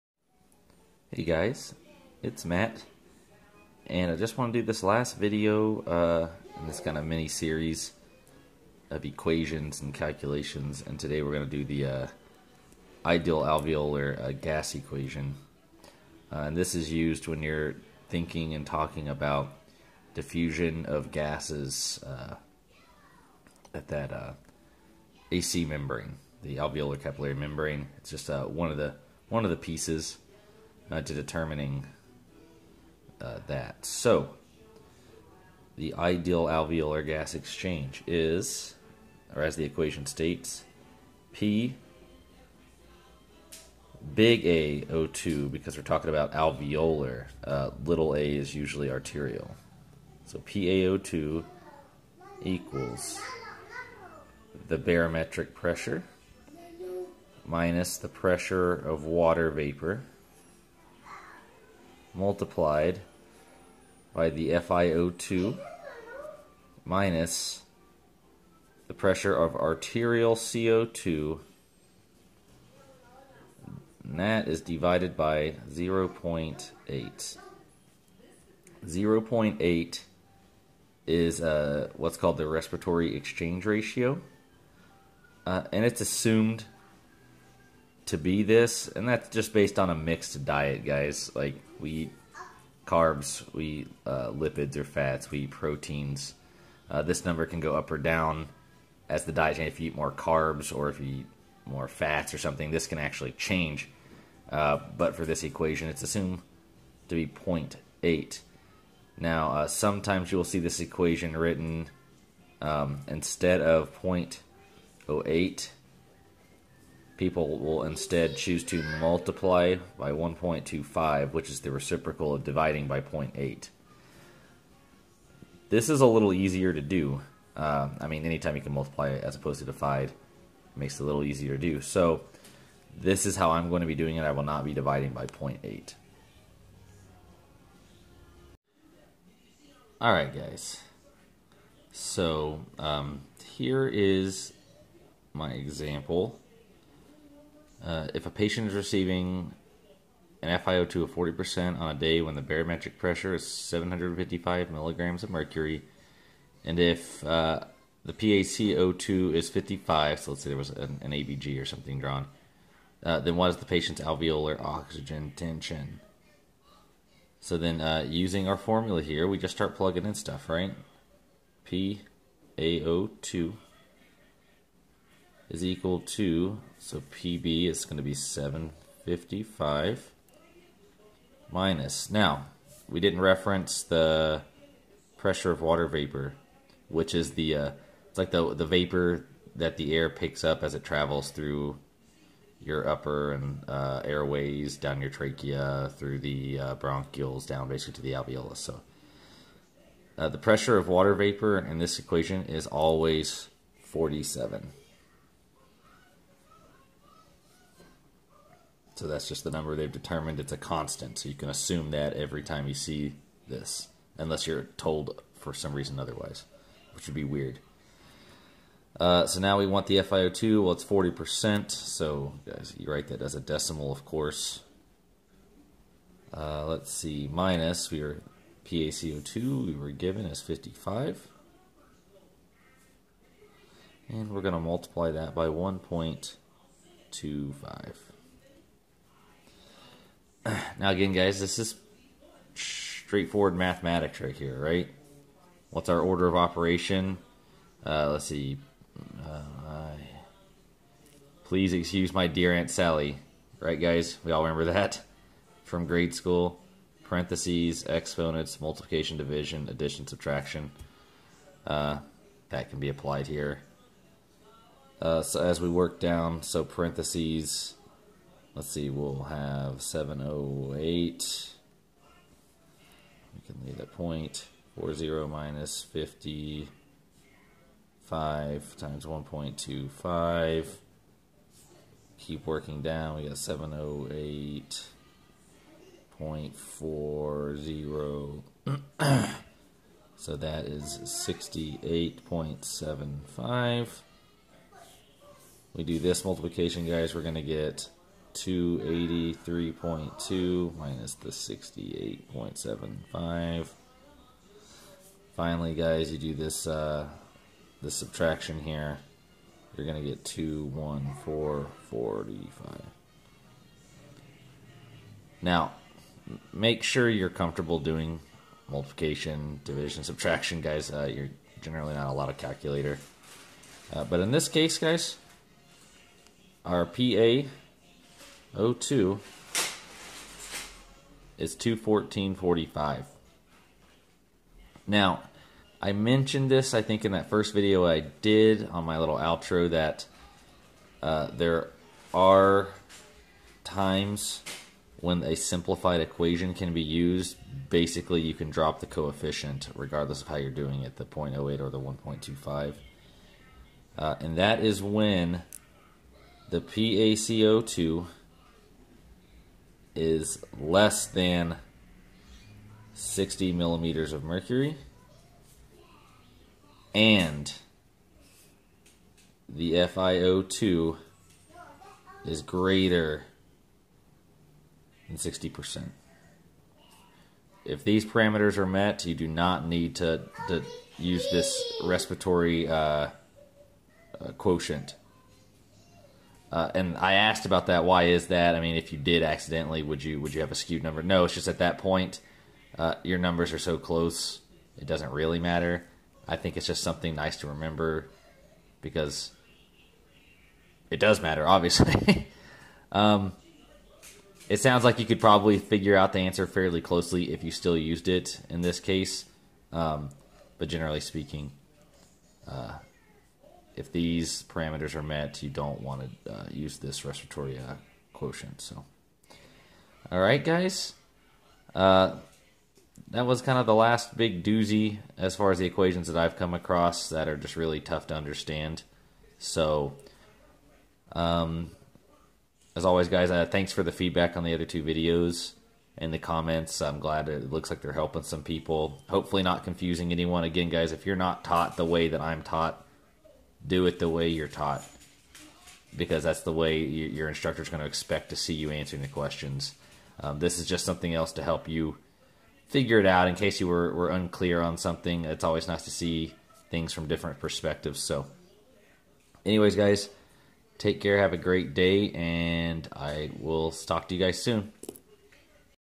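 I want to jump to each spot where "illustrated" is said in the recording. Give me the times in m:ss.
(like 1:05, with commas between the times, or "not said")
not said.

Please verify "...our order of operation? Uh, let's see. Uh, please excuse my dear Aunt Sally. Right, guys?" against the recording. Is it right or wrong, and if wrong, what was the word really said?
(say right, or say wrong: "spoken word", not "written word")
right.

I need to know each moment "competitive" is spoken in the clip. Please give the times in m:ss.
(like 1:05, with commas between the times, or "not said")
not said.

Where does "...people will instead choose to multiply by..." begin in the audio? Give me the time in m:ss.
1:57.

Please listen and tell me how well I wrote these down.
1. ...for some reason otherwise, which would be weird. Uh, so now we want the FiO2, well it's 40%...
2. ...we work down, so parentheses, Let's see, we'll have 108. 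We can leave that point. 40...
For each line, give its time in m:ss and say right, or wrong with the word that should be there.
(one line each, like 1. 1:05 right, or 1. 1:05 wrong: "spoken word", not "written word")
1. 3:35 right
2. 4:25 wrong: "708", not "108".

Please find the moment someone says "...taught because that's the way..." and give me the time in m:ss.
7:24.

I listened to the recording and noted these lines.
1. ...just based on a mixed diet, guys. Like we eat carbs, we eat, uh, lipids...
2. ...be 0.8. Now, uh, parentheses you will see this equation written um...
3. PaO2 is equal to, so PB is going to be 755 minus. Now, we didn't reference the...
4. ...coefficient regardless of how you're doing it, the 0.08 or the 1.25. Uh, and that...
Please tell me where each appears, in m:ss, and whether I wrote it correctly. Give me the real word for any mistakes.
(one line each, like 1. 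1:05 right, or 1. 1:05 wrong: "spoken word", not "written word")
1. 1:29 right
2. 1:47 wrong: "sometimes", not "parentheses"
3. 2:51 right
4. 5:48 right.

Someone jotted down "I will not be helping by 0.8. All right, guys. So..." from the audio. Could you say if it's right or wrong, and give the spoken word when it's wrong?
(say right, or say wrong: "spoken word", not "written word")
wrong: "dividing", not "helping".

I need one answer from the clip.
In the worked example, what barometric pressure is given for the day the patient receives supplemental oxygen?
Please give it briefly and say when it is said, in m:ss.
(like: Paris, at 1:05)
755 mmHg, at 2:33.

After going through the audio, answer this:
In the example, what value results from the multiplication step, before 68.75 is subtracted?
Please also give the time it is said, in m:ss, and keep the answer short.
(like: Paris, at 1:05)
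283.2, at 4:58.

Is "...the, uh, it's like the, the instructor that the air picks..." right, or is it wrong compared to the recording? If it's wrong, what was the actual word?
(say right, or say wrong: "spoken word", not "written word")
wrong: "vapor", not "instructor".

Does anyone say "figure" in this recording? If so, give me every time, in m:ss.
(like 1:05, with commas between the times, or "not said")
6:45, 7:32.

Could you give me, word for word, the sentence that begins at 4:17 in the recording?
Parentheses, exponents, multiplication, division, addition, subtraction.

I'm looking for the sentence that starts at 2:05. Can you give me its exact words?
This is a little easier to do.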